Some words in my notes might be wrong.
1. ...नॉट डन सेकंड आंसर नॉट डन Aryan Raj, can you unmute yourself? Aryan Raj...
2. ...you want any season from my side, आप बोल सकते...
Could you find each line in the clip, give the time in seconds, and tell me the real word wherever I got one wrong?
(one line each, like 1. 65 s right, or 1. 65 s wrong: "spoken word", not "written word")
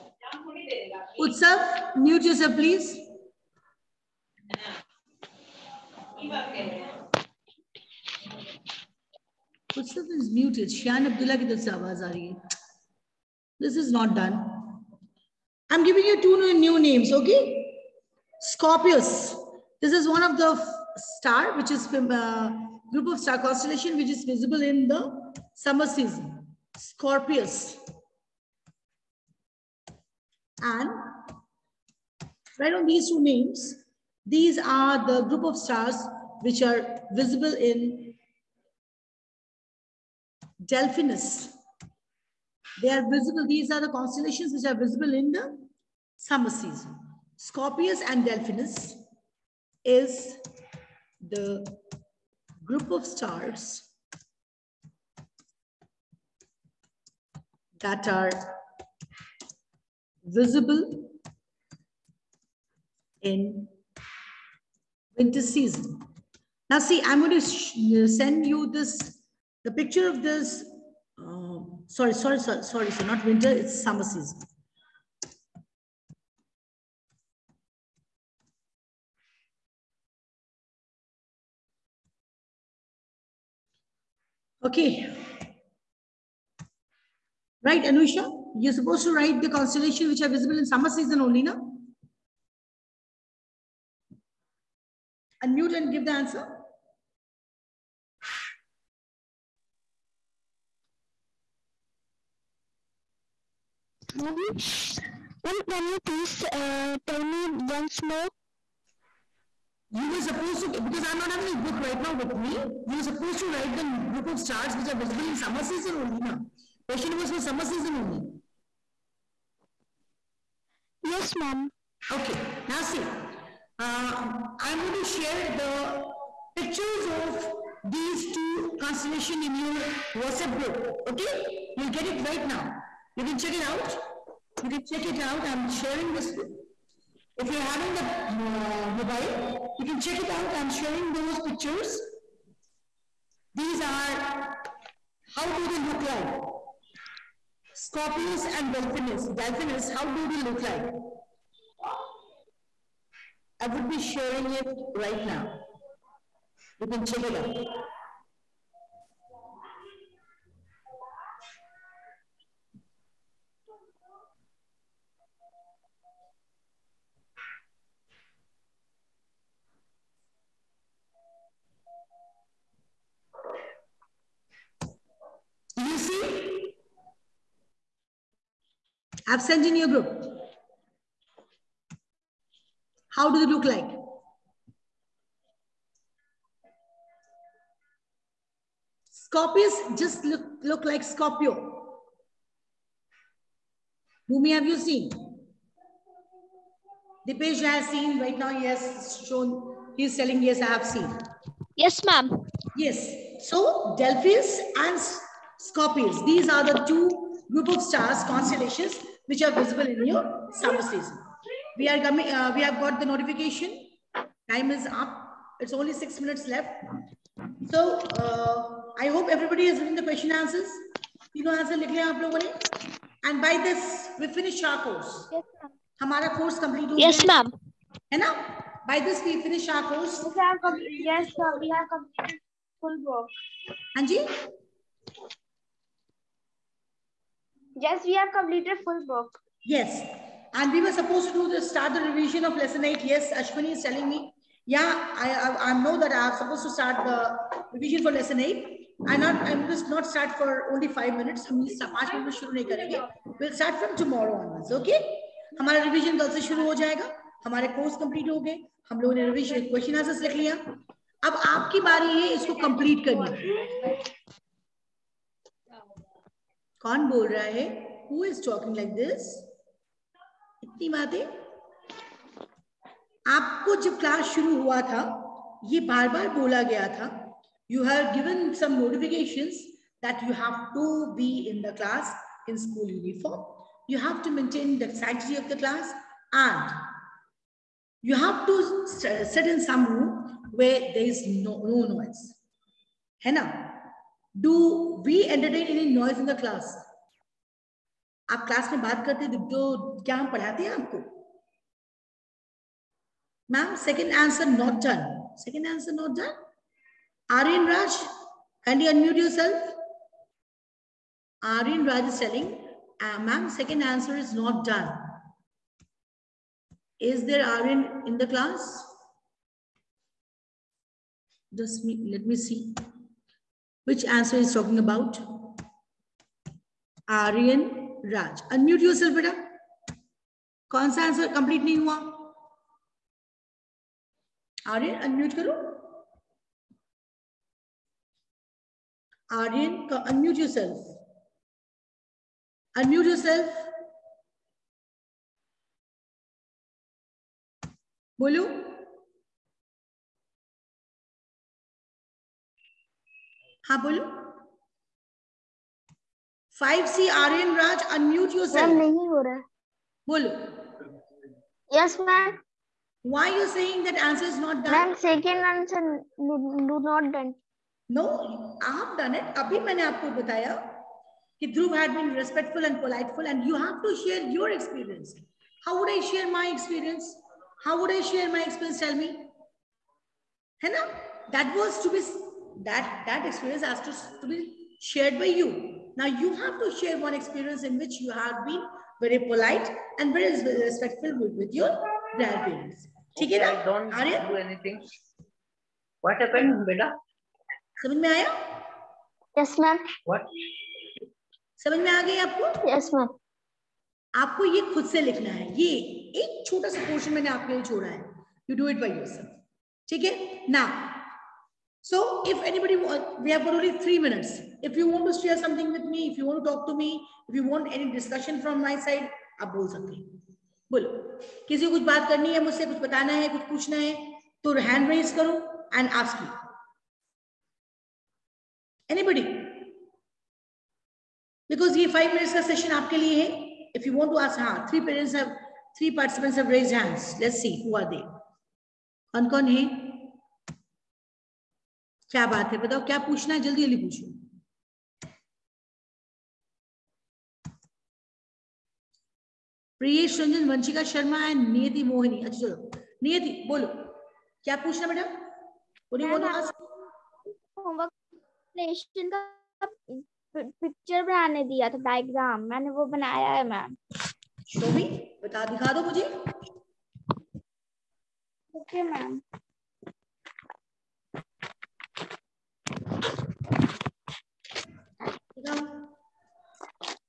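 1. 304 s right
2. 417 s wrong: "discussion", not "season".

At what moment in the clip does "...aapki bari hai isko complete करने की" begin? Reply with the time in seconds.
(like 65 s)
261 s.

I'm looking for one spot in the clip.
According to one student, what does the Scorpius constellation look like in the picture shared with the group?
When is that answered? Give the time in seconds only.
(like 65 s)
191 s.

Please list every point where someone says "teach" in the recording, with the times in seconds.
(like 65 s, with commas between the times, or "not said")
not said.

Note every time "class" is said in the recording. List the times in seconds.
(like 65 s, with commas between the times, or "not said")
318 s.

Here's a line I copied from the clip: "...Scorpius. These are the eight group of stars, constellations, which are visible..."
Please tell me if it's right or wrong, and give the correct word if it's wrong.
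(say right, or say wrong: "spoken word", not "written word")
wrong: "two", not "eight".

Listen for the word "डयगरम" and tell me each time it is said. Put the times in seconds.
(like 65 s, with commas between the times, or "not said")
461 s.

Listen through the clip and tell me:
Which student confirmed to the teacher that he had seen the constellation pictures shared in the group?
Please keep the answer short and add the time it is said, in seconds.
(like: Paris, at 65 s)
Dipesh, at 197 s.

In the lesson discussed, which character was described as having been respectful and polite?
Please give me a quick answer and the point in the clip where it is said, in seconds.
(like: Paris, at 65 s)
Dhruv, at 371 s.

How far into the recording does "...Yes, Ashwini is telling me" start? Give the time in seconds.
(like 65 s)
243 s.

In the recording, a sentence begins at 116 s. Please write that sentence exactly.
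Question was for summer season only.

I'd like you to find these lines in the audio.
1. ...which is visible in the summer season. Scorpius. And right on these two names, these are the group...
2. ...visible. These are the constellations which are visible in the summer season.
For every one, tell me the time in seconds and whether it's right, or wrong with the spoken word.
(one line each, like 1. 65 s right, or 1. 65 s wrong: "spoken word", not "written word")
1. 23 s right
2. 43 s right.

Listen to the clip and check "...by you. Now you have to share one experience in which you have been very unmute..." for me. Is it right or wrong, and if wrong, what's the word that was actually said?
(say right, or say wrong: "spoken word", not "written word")
wrong: "polite", not "unmute".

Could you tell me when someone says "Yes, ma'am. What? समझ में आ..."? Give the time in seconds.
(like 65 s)
399 s.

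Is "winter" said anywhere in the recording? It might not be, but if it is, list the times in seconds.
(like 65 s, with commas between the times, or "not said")
65 s, 73 s.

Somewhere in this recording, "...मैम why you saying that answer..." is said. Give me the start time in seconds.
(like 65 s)
362 s.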